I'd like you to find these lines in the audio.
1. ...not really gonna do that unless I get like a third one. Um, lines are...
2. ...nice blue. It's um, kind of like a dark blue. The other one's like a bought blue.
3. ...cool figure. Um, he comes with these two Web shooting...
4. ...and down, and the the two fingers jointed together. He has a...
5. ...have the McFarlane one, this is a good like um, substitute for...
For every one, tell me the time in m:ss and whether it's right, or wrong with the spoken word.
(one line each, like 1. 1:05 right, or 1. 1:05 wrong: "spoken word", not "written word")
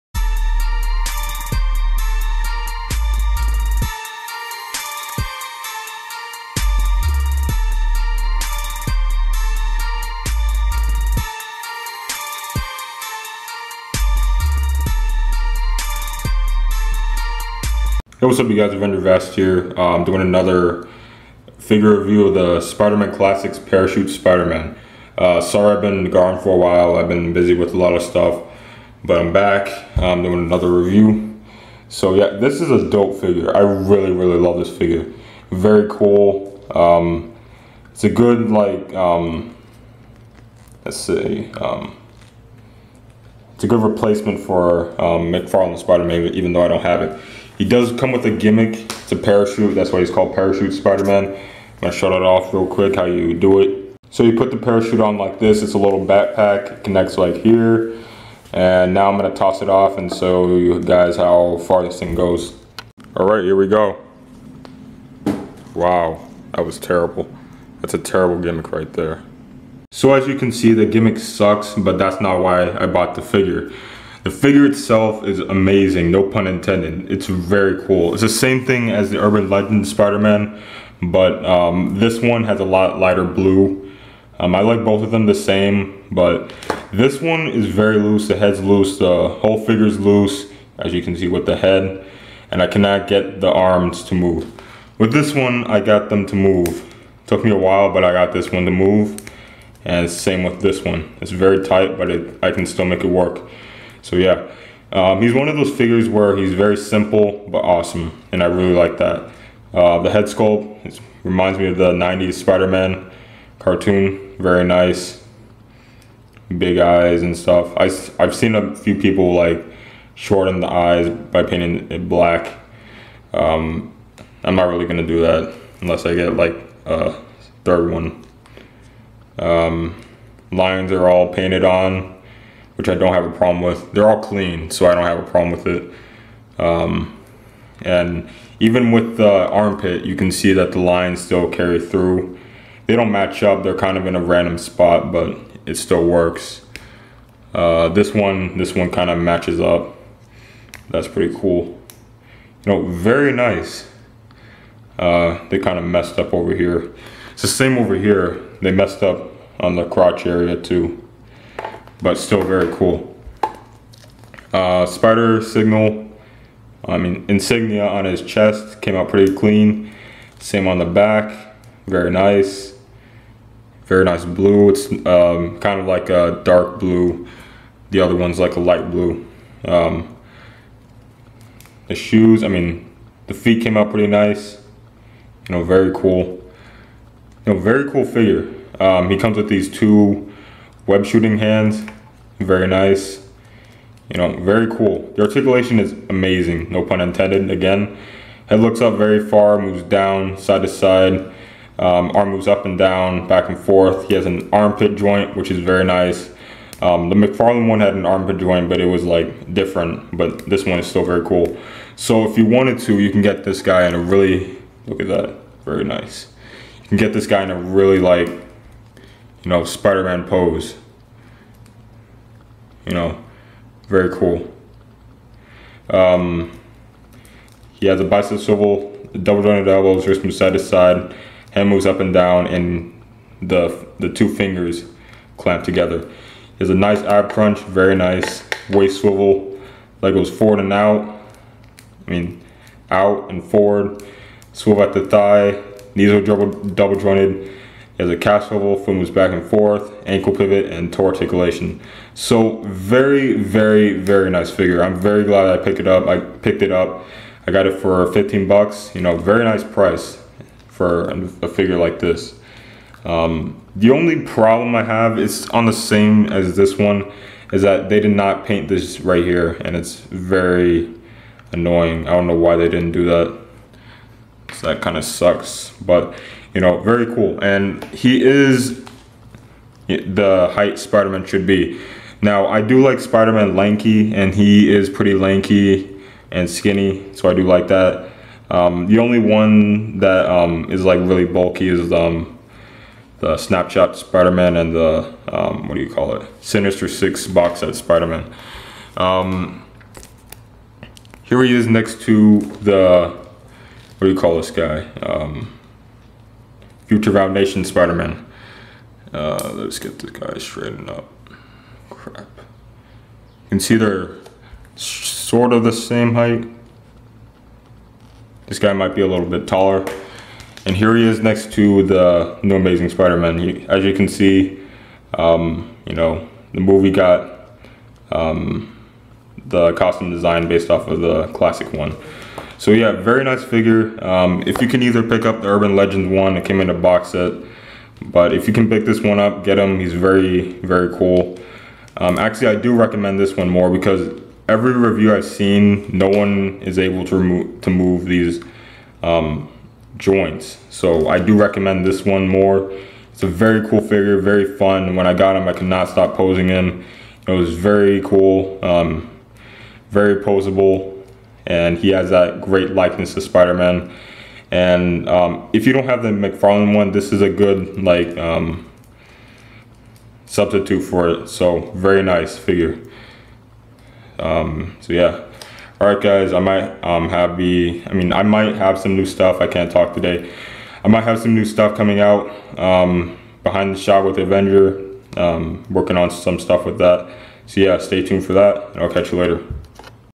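1. 2:04 right
2. 2:54 wrong: "light", not "bought"
3. 3:07 right
4. 3:51 wrong: "clamped", not "jointed"
5. 6:05 right.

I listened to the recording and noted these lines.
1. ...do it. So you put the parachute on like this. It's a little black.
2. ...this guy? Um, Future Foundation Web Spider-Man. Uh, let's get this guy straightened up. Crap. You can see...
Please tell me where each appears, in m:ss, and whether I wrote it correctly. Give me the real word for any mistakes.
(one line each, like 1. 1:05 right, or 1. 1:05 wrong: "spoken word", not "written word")
1. 0:53 wrong: "backpack", not "black"
2. 5:04 wrong: "Nation", not "Web".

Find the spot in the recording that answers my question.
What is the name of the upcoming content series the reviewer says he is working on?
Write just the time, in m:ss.
6:23.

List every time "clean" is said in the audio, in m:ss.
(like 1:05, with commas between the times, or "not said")
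2:14, 2:49.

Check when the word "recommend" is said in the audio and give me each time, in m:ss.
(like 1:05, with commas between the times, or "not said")
5:42, 5:51.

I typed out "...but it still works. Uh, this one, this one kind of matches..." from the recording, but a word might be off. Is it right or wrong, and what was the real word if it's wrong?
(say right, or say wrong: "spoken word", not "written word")
right.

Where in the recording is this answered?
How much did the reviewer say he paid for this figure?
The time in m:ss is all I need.
4:18.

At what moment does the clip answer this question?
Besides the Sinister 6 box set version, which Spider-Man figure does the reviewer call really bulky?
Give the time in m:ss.
4:53.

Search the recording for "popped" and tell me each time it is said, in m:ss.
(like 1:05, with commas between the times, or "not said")
not said.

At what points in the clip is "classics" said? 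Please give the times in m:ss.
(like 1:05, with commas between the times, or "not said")
0:23, 5:31.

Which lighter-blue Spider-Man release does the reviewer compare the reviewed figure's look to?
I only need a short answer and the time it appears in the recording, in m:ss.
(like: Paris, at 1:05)
Urban Legend Spider-Man, at 1:19.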